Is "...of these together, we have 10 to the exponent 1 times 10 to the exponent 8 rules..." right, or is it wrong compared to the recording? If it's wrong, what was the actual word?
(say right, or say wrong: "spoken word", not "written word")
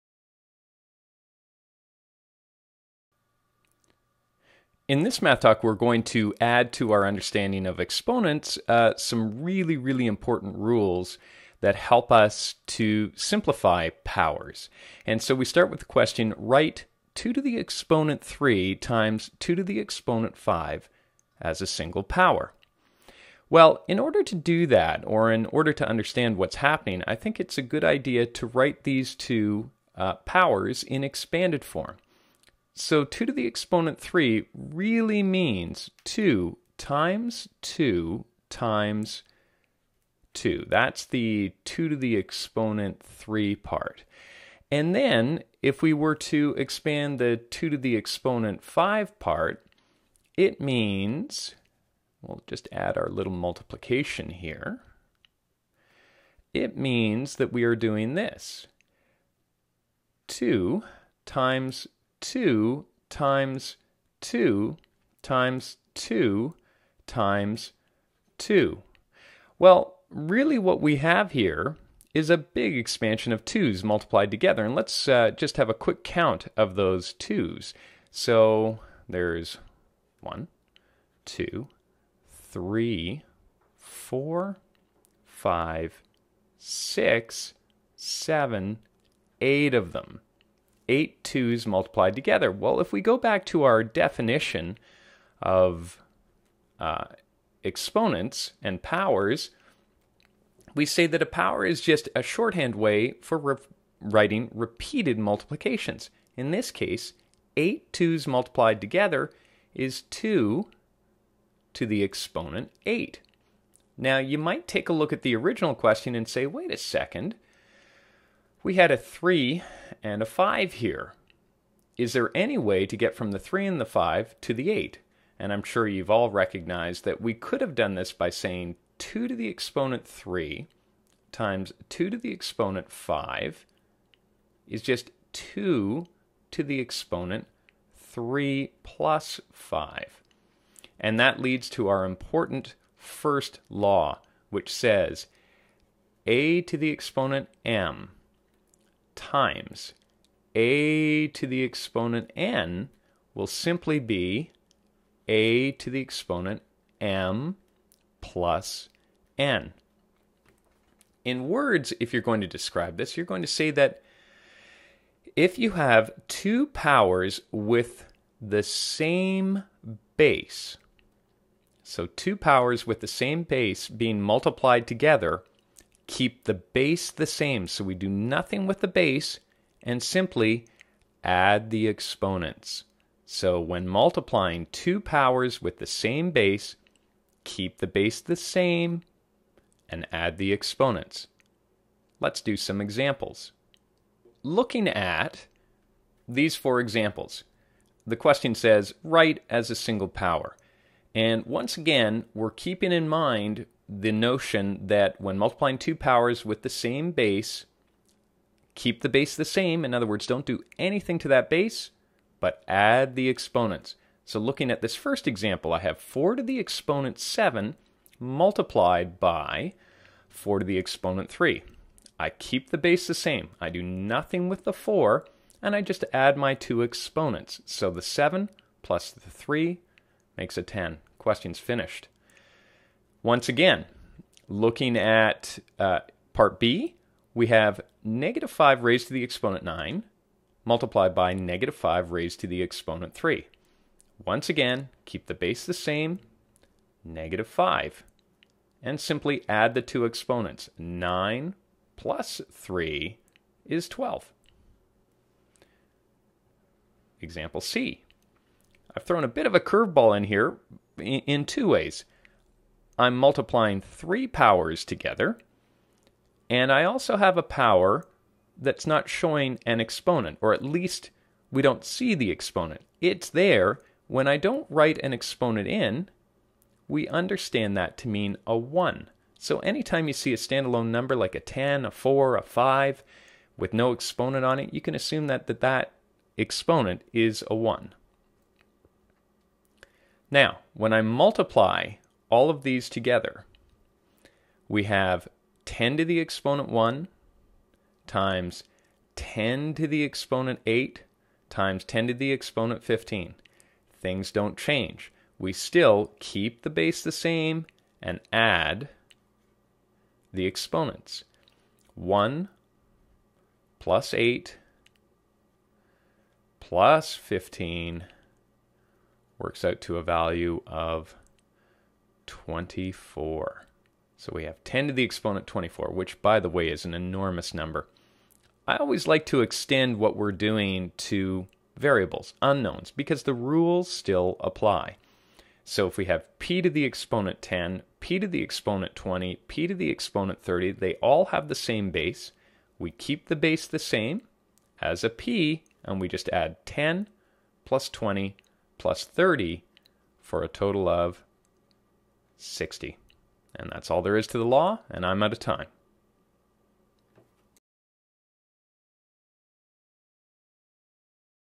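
wrong: "times", not "rules".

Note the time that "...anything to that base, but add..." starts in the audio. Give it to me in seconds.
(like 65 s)
210 s.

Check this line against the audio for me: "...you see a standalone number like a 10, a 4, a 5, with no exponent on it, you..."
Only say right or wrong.
right.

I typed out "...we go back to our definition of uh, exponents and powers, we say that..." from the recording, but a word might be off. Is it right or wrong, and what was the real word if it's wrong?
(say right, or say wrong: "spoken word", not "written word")
right.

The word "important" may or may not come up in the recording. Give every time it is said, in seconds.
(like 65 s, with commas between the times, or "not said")
10 s, 142 s.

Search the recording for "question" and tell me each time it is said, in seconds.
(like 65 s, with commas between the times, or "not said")
15 s, 115 s, 198 s, 231 s.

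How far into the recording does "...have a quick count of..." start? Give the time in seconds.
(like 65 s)
75 s.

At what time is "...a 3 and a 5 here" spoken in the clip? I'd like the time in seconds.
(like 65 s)
118 s.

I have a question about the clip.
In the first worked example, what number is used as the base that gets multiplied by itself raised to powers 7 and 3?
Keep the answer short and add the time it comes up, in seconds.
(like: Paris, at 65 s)
4, at 215 s.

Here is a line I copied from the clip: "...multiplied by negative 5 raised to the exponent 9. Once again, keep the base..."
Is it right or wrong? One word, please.
wrong.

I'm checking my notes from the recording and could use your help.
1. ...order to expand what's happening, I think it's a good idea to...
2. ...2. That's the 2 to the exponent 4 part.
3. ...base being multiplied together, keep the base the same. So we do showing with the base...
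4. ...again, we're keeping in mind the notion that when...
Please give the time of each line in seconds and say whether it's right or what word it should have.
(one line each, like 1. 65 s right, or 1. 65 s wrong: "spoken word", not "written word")
1. 25 s wrong: "understand", not "expand"
2. 40 s wrong: "3", not "4"
3. 173 s wrong: "nothing", not "showing"
4. 201 s right.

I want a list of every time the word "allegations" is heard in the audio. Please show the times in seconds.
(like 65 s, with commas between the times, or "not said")
not said.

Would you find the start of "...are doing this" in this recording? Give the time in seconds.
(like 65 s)
57 s.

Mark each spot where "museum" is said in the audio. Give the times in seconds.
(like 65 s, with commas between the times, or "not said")
not said.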